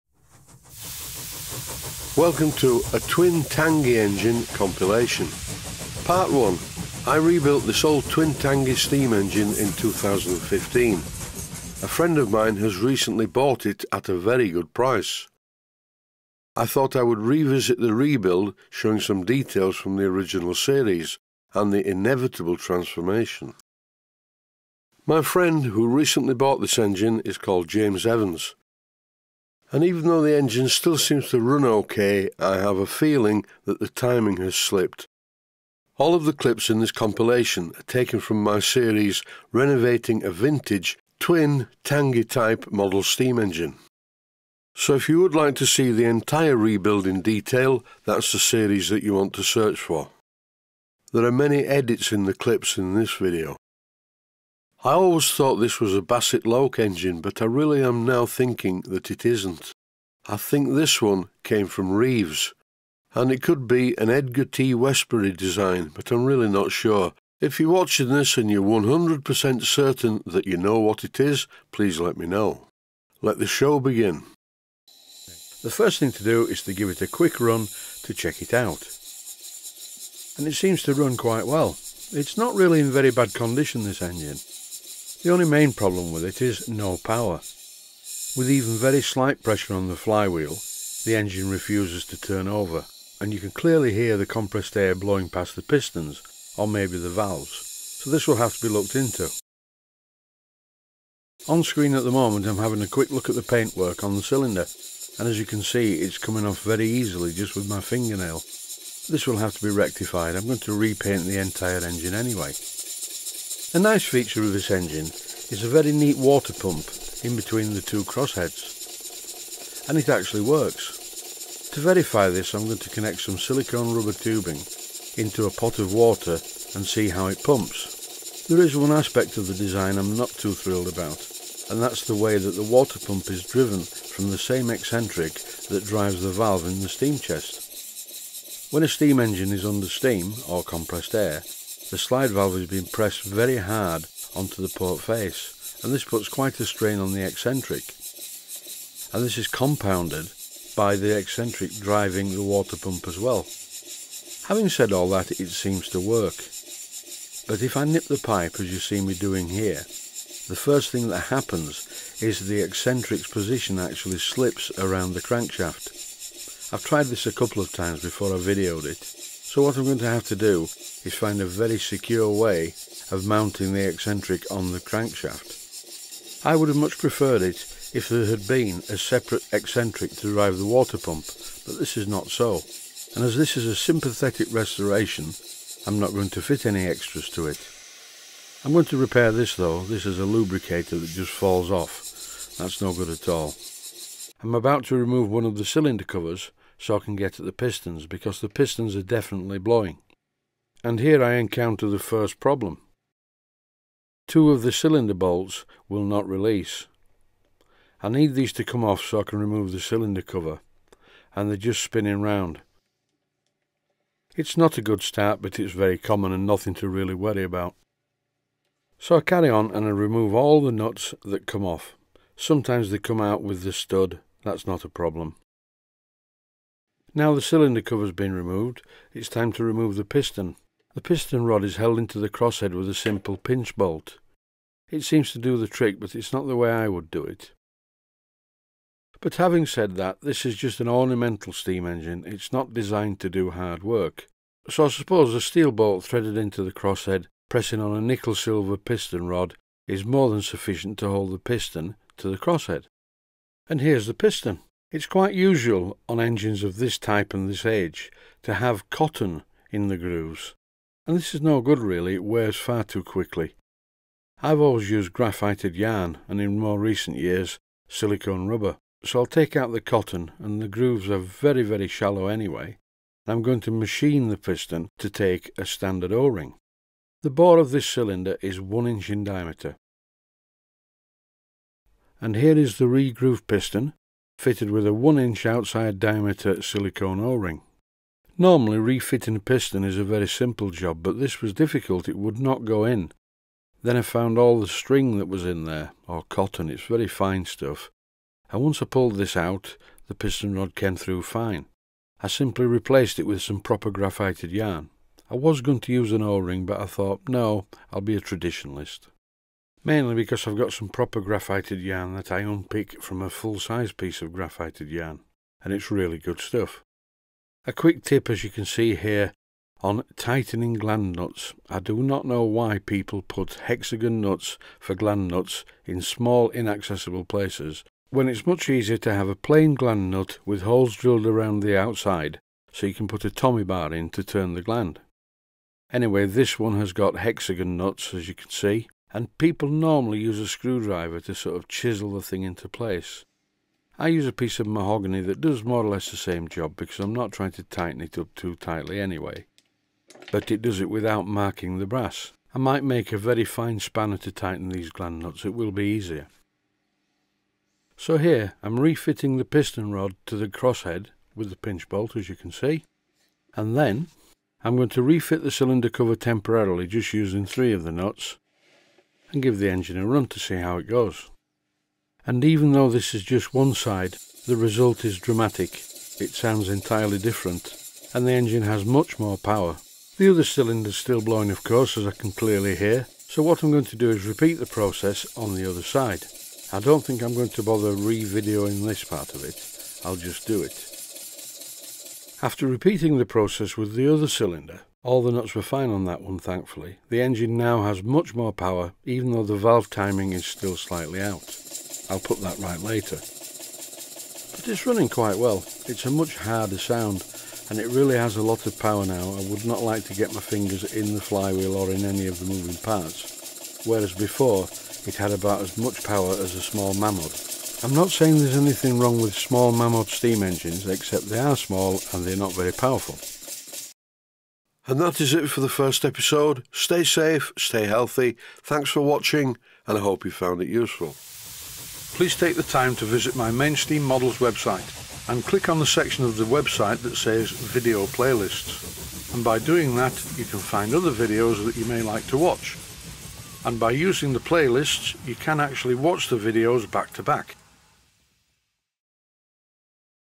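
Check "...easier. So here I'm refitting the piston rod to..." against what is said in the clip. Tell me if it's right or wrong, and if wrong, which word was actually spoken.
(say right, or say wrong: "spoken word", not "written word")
right.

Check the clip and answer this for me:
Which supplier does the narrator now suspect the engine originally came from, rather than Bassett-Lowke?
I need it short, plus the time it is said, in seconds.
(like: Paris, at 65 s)
Reeves, at 61 s.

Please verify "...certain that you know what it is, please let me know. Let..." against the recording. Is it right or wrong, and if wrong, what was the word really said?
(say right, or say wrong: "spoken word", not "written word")
right.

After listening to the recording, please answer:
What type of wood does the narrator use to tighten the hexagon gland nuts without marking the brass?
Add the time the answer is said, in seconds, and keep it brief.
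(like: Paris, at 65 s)
Mahogany, at 344 s.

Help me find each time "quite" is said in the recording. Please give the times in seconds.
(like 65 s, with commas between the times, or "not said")
81 s, 146 s, 255 s, 405 s.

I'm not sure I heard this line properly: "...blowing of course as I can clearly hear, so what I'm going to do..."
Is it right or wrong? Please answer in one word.
right.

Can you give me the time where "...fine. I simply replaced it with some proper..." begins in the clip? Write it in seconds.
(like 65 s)
301 s.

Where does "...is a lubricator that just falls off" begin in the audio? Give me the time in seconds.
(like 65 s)
190 s.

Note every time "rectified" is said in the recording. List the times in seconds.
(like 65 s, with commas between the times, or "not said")
109 s.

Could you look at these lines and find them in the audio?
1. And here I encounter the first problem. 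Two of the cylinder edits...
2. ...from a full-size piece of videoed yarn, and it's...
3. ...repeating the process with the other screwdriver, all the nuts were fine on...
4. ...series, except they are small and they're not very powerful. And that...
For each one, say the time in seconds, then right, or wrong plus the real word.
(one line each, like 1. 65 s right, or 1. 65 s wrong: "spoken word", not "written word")
1. 200 s wrong: "bolts", not "edits"
2. 313 s wrong: "graphited", not "videoed"
3. 392 s wrong: "cylinder", not "screwdriver"
4. 420 s wrong: "engines", not "series".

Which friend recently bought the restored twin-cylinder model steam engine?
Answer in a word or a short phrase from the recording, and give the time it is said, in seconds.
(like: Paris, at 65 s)
James Evans, at 27 s.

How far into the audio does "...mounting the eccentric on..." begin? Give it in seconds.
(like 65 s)
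173 s.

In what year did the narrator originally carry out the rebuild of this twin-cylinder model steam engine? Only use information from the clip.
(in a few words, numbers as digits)
2015.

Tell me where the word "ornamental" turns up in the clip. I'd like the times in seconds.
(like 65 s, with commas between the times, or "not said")
240 s.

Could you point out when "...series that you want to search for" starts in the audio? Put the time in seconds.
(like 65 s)
48 s.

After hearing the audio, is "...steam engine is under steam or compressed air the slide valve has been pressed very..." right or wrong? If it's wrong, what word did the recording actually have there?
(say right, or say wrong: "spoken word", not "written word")
right.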